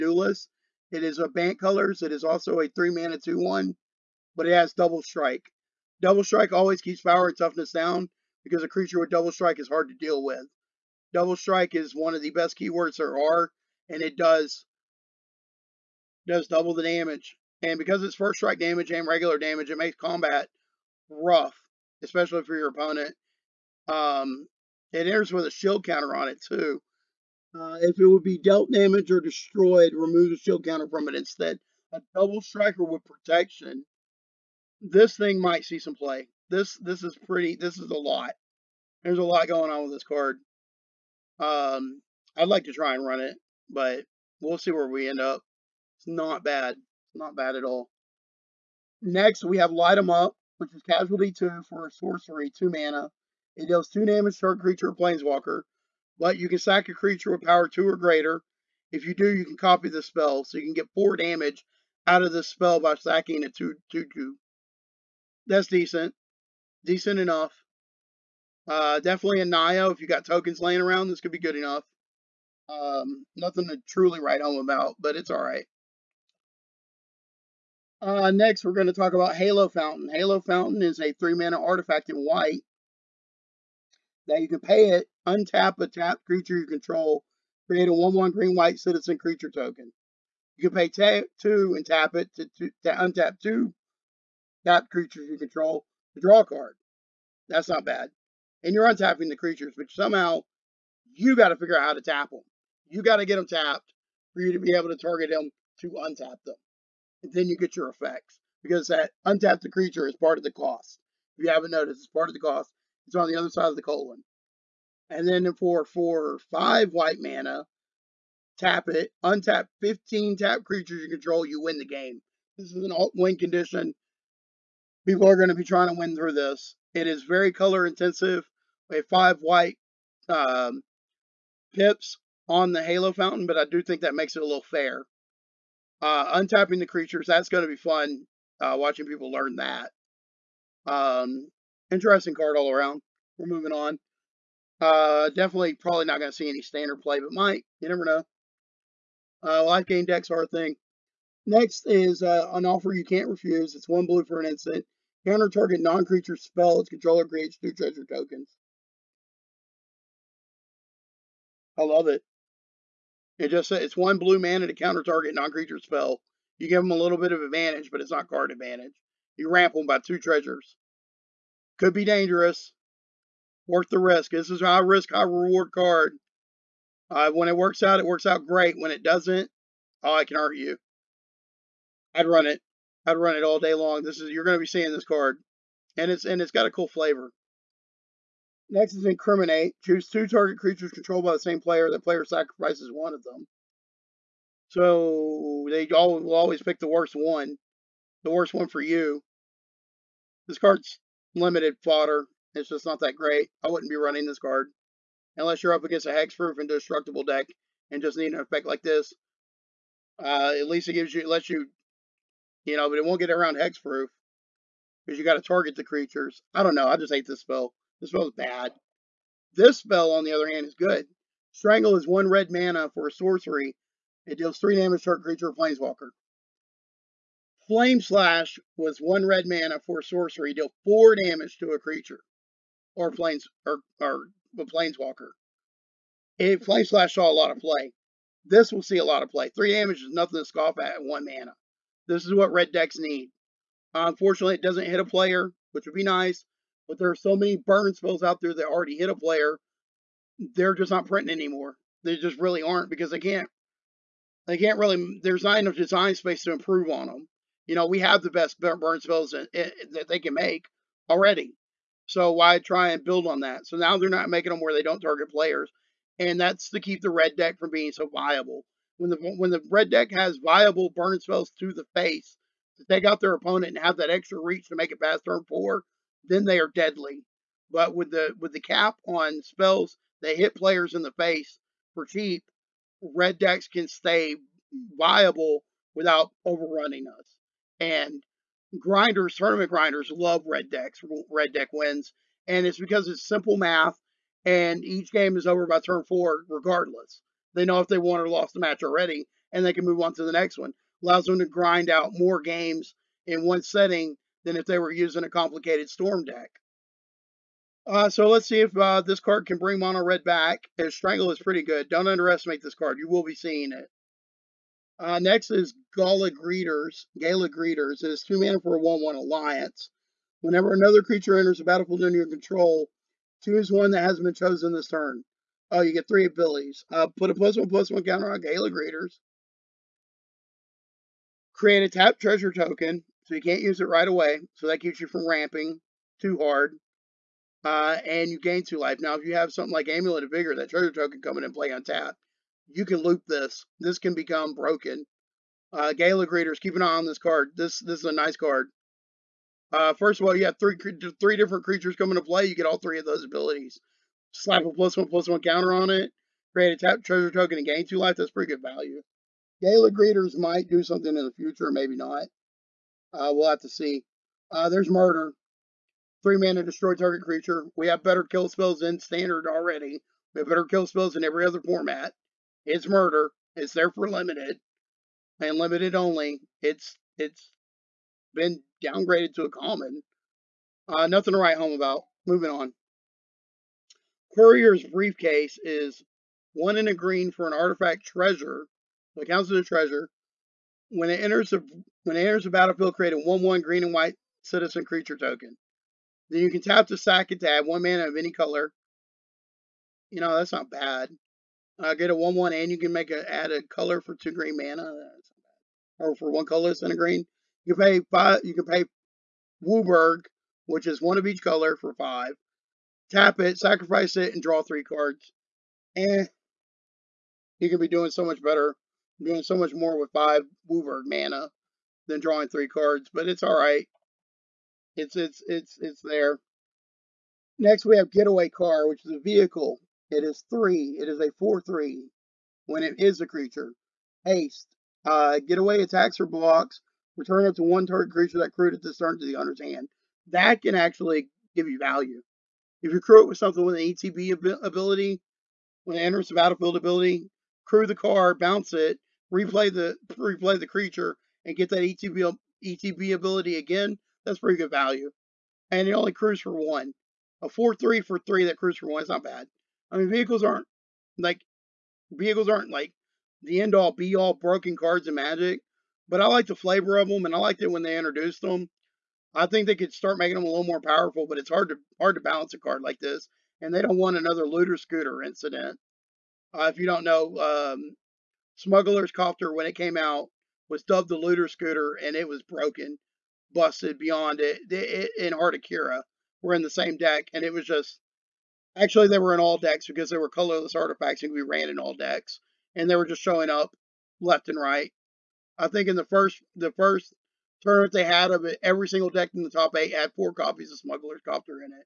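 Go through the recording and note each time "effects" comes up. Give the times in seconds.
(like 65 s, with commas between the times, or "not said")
107 s, 208 s.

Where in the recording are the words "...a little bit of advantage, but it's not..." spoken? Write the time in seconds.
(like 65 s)
166 s.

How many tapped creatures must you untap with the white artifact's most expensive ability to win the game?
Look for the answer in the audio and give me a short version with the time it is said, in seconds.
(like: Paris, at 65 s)
15, at 119 s.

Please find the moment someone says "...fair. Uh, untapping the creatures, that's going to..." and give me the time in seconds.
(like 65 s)
134 s.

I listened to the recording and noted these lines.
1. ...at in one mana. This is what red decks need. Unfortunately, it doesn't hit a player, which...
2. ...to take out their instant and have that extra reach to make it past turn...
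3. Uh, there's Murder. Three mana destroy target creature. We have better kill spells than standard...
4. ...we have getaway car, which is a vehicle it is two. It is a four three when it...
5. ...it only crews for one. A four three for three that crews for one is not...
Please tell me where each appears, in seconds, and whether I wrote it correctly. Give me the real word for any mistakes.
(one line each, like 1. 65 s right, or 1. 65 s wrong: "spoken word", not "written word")
1. 240 s right
2. 272 s wrong: "opponent", not "instant"
3. 364 s right
4. 427 s wrong: "three", not "two"
5. 455 s right.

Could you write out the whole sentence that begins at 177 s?
Uh, when it works out, it works out great.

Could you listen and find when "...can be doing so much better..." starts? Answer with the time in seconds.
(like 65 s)
417 s.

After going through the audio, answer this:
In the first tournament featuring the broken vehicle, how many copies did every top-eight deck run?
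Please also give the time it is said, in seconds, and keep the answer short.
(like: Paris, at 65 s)
4, at 500 s.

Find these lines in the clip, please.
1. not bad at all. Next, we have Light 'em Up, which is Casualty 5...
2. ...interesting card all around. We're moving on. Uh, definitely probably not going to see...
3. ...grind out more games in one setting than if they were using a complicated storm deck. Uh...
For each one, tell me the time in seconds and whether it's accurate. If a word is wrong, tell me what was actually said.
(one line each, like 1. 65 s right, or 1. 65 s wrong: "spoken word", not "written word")
1. 47 s wrong: "2", not "5"
2. 141 s right
3. 301 s right.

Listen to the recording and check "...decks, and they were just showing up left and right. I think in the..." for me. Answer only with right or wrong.
right.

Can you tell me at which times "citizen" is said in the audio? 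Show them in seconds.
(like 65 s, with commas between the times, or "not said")
88 s, 394 s.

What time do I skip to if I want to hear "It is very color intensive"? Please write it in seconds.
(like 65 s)
126 s.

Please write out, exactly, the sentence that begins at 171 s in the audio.
Could be dangerous worth the risk.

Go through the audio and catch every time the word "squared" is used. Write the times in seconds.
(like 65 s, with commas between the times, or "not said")
not said.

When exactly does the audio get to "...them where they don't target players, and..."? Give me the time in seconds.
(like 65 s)
264 s.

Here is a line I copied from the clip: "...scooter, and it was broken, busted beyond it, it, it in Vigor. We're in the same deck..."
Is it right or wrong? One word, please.
wrong.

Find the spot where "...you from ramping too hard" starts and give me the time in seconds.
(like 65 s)
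335 s.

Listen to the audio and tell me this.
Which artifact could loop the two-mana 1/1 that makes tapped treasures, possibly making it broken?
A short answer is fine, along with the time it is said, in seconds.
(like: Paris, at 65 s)
Amulet of Vigor, at 339 s.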